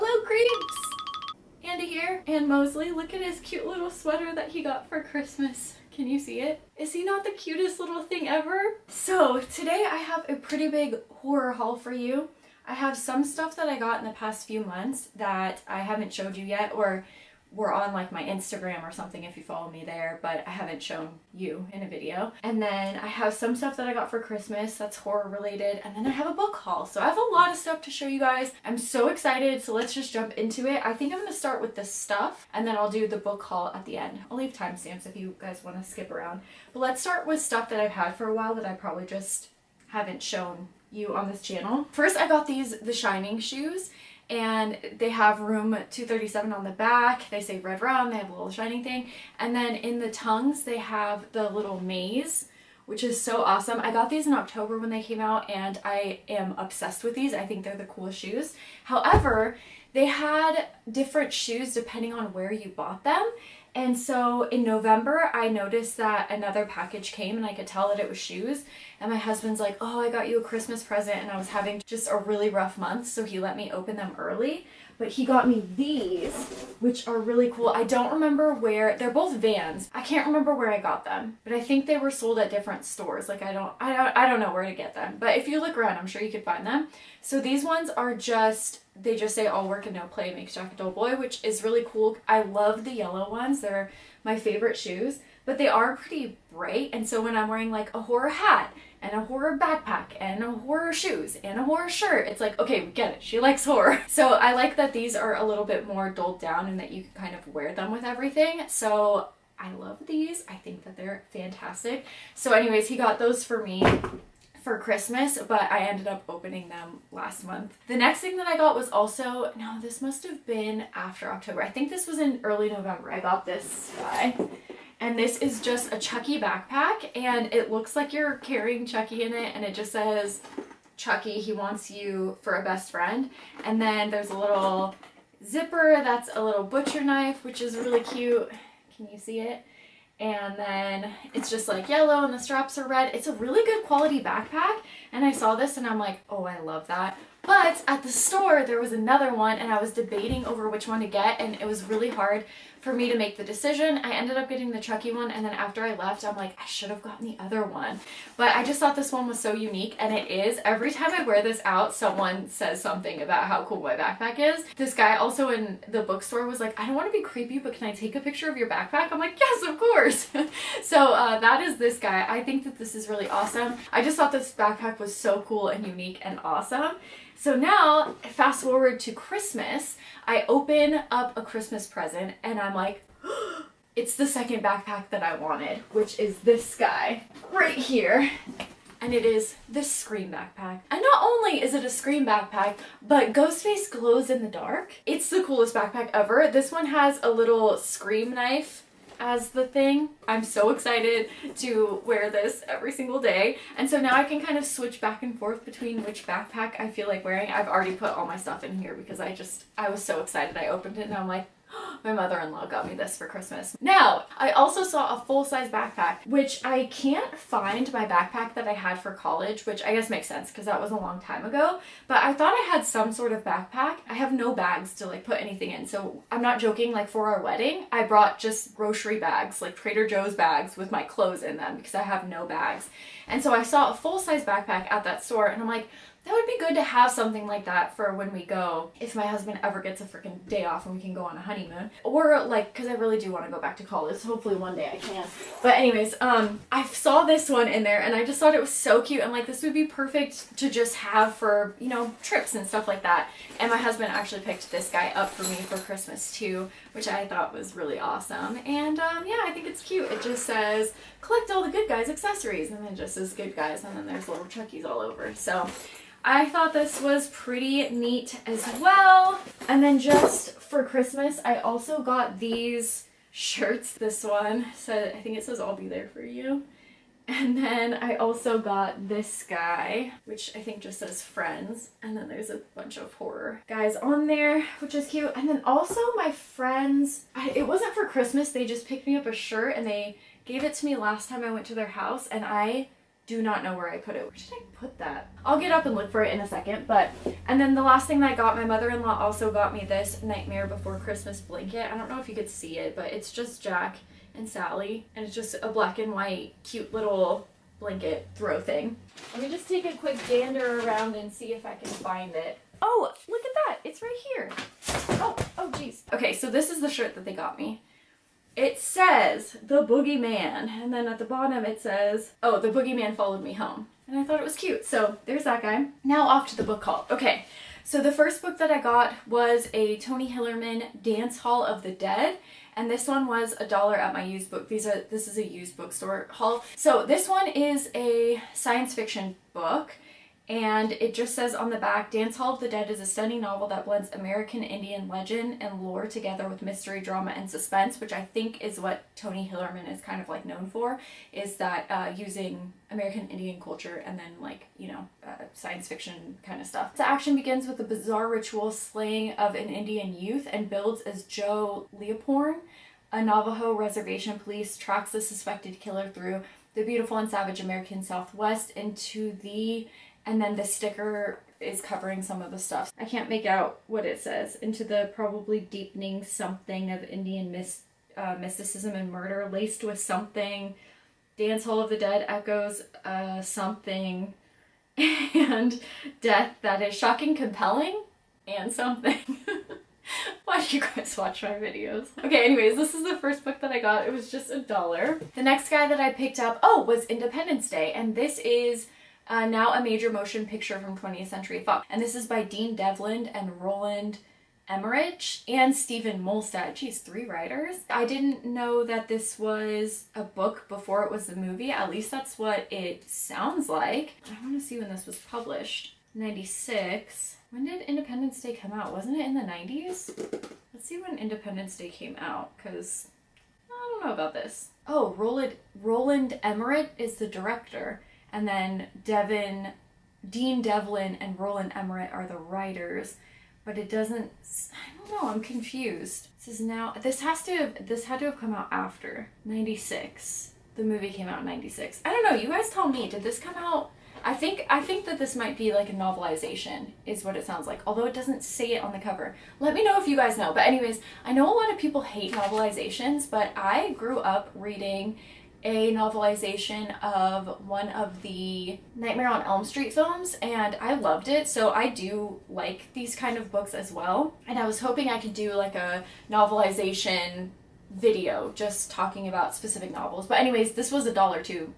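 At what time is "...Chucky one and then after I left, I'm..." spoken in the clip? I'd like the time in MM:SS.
02:34.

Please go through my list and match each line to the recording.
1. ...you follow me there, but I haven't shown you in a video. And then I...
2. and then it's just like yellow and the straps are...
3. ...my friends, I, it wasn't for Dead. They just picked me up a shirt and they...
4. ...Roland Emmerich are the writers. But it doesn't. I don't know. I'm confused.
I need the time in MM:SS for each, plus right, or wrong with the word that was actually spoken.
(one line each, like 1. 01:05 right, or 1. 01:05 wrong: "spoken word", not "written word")
1. 00:19 right
2. 02:20 right
3. 04:46 wrong: "Christmas", not "Dead"
4. 07:11 right.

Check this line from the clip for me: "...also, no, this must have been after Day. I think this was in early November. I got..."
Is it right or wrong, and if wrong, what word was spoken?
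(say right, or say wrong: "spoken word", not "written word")
wrong: "October", not "Day".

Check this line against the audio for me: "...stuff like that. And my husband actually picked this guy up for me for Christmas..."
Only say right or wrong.
right.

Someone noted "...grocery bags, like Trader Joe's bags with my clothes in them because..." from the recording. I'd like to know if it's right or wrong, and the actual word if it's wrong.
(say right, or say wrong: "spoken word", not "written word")
right.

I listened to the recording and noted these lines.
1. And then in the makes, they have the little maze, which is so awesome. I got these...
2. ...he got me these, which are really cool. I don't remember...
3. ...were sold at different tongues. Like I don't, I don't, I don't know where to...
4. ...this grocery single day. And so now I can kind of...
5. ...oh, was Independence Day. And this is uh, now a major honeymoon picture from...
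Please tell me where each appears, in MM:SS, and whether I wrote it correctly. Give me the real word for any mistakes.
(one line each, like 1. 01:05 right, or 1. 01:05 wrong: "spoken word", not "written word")
1. 00:49 wrong: "tongues", not "makes"
2. 01:15 right
3. 01:21 wrong: "stores", not "tongues"
4. 03:22 wrong: "every", not "grocery"
5. 06:36 wrong: "motion", not "honeymoon".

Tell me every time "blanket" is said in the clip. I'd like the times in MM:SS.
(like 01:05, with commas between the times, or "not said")
05:01, 05:07.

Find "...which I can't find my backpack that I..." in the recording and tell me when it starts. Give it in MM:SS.
03:36.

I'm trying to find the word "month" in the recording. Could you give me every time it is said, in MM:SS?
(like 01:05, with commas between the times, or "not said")
00:14, 01:12, 01:57.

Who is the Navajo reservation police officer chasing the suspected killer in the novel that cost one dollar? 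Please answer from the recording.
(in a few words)
Joe Leaphorn.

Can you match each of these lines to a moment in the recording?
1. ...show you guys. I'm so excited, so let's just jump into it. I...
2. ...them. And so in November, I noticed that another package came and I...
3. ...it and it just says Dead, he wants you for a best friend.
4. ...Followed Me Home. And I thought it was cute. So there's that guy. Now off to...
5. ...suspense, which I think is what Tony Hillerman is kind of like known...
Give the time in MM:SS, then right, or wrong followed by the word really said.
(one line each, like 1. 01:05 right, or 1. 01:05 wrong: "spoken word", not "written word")
1. 00:27 right
2. 01:03 right
3. 02:09 wrong: "Chucky", not "Dead"
4. 05:23 right
5. 05:47 right.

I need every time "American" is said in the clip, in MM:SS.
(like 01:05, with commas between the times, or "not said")
05:44, 05:52, 06:07.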